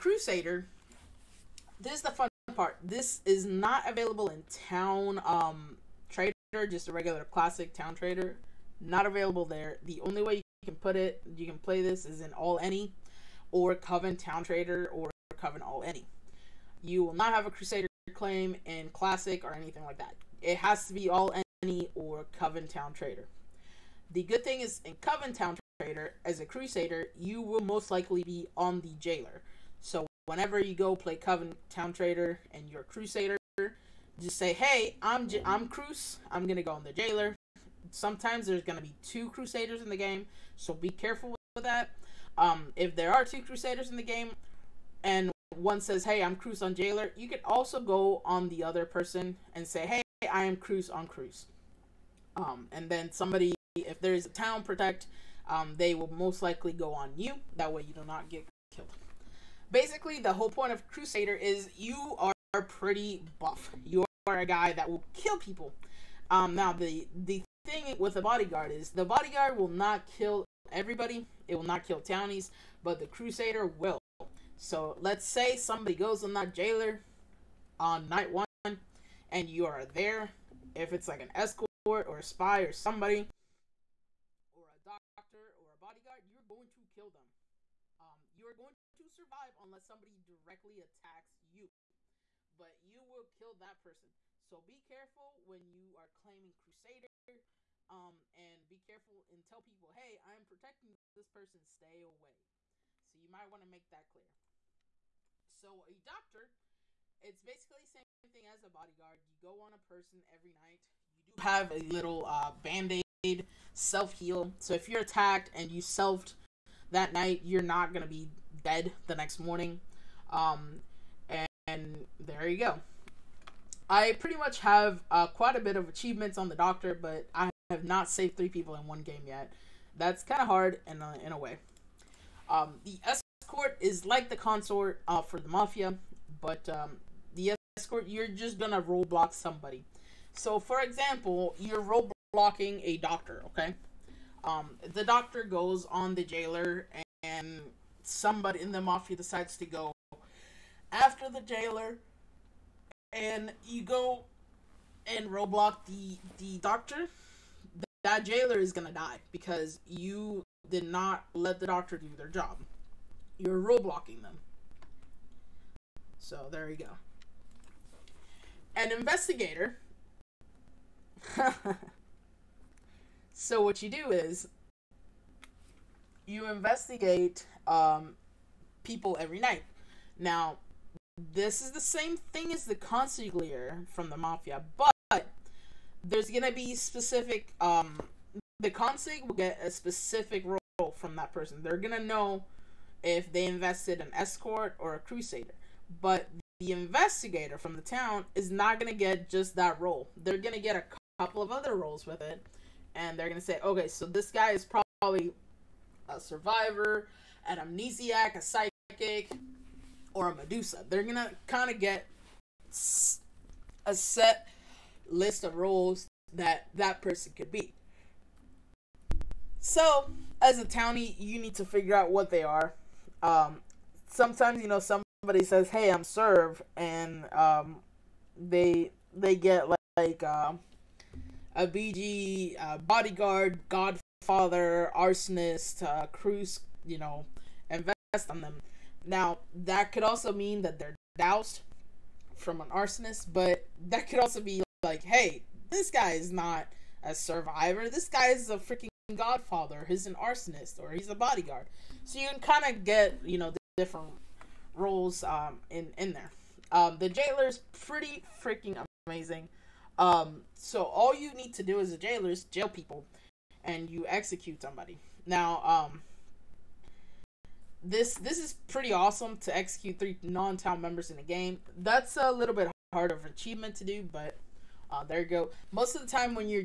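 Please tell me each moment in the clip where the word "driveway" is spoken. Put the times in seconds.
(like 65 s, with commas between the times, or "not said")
not said.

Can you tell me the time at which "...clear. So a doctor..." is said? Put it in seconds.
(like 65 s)
104 s.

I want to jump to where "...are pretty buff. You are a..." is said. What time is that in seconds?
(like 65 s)
62 s.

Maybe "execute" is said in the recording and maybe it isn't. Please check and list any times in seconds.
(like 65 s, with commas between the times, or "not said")
264 s, 269 s.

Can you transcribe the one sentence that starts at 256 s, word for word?
Um, the jailer's pretty freaking amazing.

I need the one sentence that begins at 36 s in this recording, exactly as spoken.
I'm gonna go on the Jailer." Sometimes there's gonna be two Crusaders in the game, so be careful with that.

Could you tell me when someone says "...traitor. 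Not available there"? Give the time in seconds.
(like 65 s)
7 s.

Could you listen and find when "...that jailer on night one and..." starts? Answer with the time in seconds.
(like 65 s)
76 s.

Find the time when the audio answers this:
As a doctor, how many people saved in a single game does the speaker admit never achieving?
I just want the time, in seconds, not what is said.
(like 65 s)
128 s.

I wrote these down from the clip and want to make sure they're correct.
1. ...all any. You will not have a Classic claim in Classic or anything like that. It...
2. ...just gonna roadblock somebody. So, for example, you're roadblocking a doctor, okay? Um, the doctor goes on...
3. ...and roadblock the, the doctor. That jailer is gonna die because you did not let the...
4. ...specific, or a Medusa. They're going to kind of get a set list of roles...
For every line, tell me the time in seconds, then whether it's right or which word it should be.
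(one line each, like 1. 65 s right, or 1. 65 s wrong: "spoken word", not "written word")
1. 15 s wrong: "Crusader", not "Classic"
2. 138 s right
3. 155 s right
4. 208 s wrong: "psychic", not "specific".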